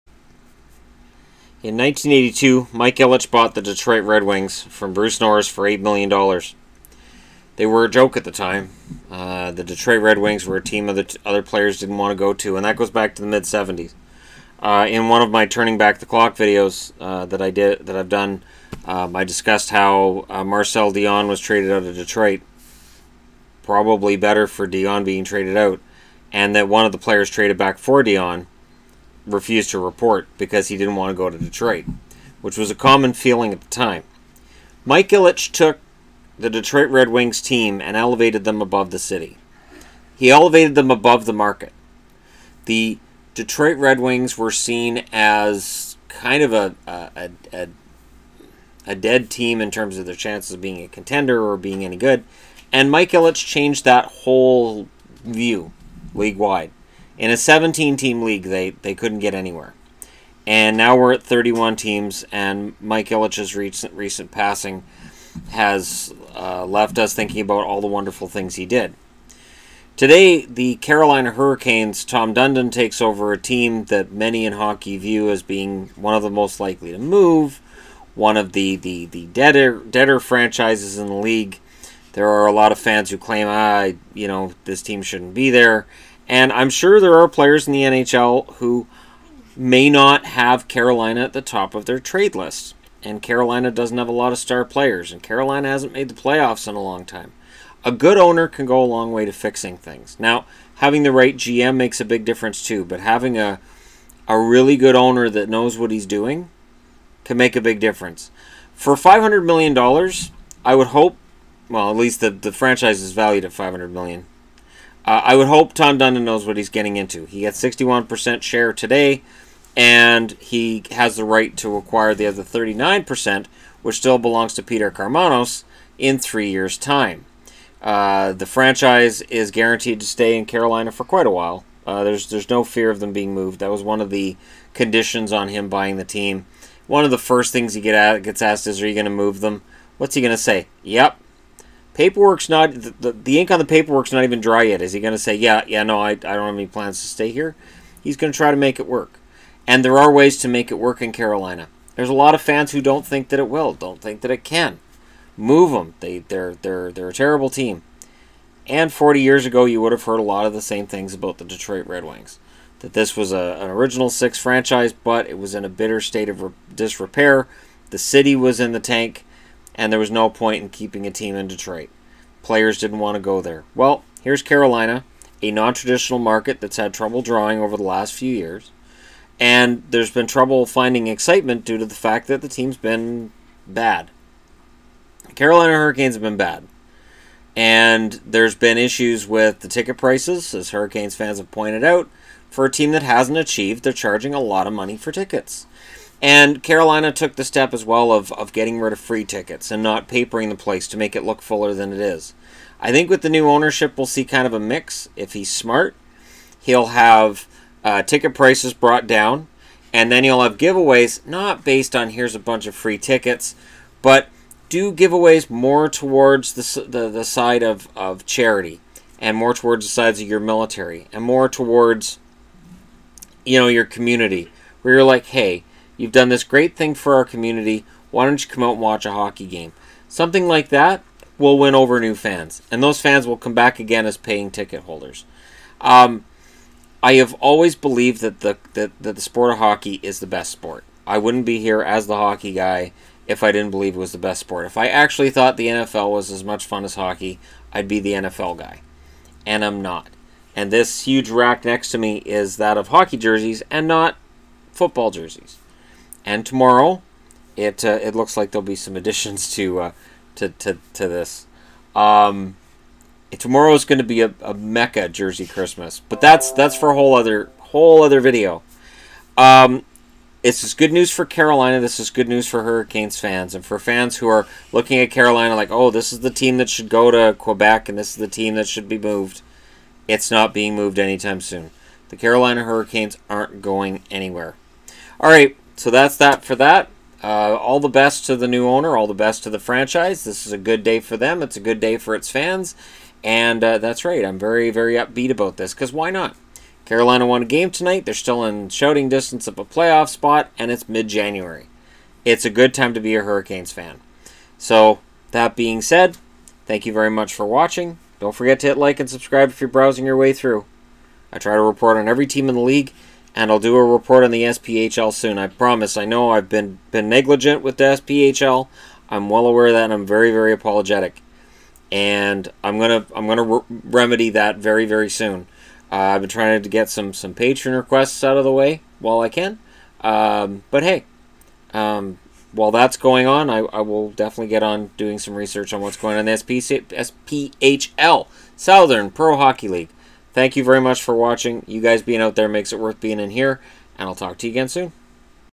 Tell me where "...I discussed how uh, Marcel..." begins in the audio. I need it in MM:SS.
00:19.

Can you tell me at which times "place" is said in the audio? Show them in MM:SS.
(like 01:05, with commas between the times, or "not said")
03:20.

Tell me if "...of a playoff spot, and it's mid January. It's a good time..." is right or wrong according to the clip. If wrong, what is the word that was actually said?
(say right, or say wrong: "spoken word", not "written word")
right.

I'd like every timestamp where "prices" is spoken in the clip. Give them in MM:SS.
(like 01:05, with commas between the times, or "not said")
03:09, 03:28.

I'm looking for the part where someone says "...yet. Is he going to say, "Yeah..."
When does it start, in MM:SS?
02:24.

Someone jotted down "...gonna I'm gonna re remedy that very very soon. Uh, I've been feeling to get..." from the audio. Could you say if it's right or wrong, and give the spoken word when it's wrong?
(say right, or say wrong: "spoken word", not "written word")
wrong: "trying", not "feeling".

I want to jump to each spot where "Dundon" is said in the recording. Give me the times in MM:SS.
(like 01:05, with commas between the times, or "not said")
01:12, 01:55.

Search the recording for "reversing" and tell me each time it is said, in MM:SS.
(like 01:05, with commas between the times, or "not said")
not said.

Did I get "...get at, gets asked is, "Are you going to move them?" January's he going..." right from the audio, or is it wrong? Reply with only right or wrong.
wrong.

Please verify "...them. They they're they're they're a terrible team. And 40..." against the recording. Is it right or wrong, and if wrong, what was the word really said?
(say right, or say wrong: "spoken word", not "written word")
right.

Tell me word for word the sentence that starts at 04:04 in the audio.
If I actually thought the NFL was as much fun as hockey, I'd be the NFL guy.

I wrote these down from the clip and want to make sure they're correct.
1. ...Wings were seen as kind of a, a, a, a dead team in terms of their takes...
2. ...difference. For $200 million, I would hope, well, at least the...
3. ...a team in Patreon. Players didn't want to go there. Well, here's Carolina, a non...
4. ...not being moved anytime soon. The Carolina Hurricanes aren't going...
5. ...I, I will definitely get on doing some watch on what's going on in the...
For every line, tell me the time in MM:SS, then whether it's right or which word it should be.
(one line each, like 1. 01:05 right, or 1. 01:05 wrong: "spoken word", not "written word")
1. 00:43 wrong: "chances", not "takes"
2. 01:47 wrong: "500", not "200"
3. 02:51 wrong: "Detroit", not "Patreon"
4. 04:40 right
5. 05:33 wrong: "research", not "watch".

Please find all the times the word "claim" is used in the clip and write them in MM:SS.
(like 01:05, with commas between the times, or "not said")
01:23.